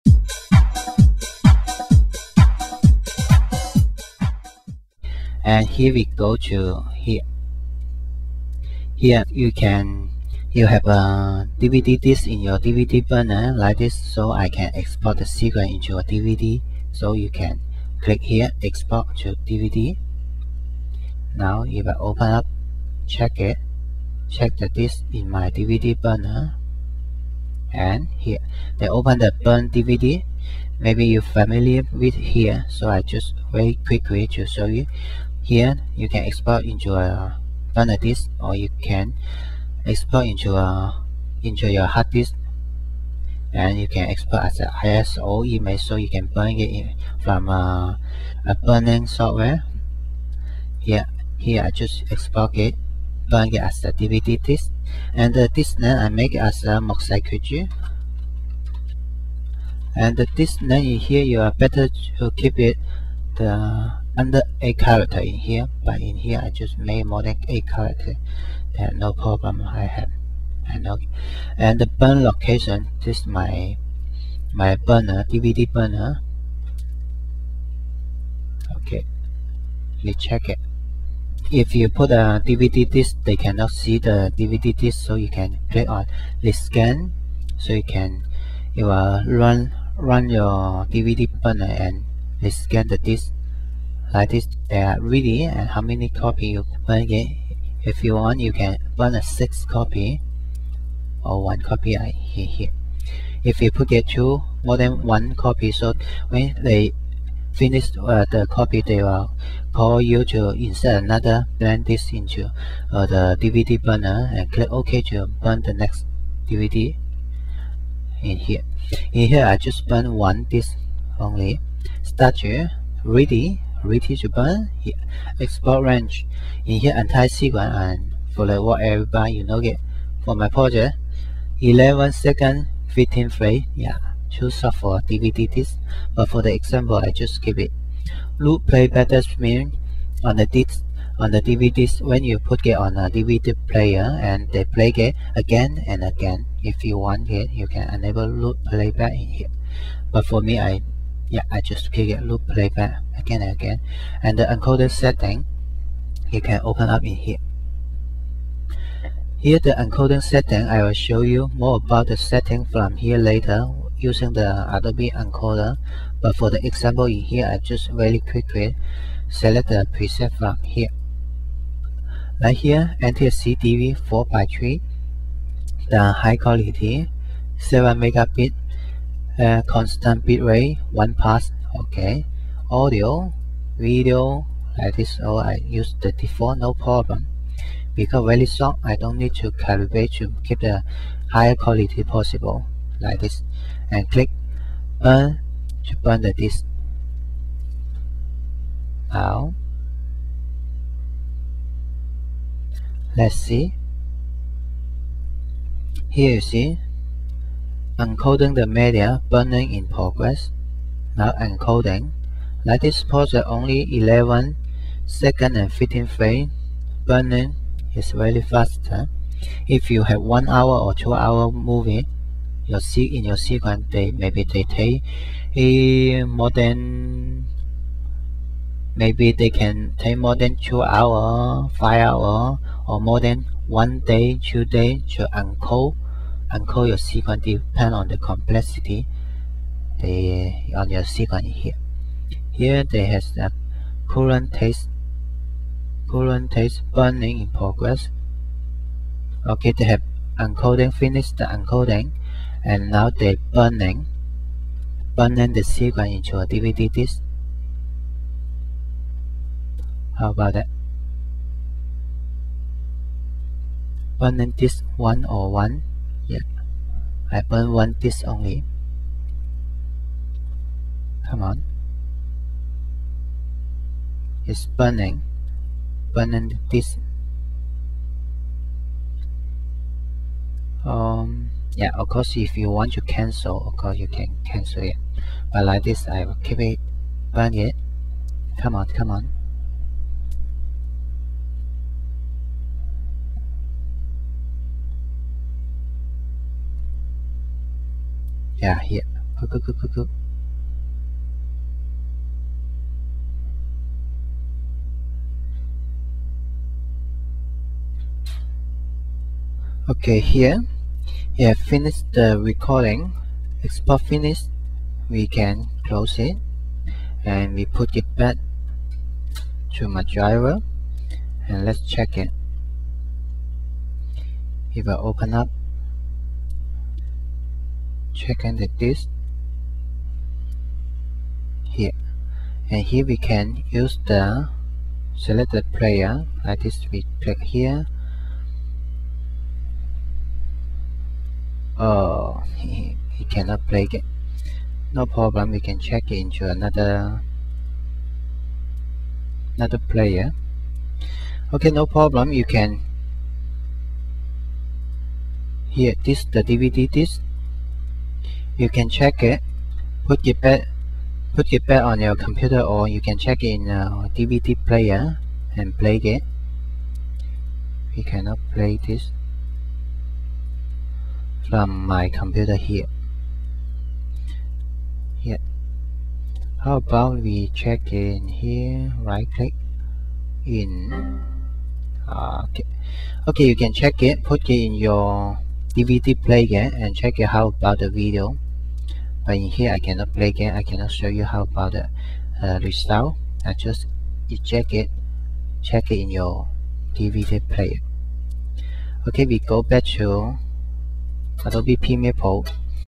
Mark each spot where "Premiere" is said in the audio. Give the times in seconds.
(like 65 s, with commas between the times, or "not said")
401 s.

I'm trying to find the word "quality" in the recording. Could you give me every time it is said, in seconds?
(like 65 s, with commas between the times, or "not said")
176 s, 191 s.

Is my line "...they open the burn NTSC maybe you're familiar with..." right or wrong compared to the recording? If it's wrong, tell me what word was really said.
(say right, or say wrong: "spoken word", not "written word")
wrong: "DVD", not "NTSC".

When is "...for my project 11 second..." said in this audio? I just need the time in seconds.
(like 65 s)
130 s.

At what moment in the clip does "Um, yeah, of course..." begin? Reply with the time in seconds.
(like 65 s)
280 s.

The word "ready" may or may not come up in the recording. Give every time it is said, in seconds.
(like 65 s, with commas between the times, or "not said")
94 s, 123 s.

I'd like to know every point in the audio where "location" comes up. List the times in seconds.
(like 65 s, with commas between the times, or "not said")
72 s.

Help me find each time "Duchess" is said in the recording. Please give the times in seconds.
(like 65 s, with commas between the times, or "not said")
not said.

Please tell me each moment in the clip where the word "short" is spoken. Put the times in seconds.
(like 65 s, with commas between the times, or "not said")
188 s.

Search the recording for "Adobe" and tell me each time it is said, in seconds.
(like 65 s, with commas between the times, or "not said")
164 s, 401 s.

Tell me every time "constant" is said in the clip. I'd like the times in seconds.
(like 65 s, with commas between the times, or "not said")
179 s.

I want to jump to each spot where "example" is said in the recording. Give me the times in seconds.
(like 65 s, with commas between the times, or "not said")
136 s, 166 s.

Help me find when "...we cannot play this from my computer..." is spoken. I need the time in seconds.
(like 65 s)
367 s.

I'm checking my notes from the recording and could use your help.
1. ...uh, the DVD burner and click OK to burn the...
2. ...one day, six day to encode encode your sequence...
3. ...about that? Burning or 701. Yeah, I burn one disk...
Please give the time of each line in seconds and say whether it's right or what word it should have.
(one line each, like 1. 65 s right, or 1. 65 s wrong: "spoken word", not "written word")
1. 112 s right
2. 233 s wrong: "two", not "six"
3. 260 s wrong: "101", not "701".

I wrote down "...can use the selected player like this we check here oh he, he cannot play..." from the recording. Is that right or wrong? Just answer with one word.
wrong.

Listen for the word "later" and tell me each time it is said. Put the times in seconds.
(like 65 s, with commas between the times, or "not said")
163 s.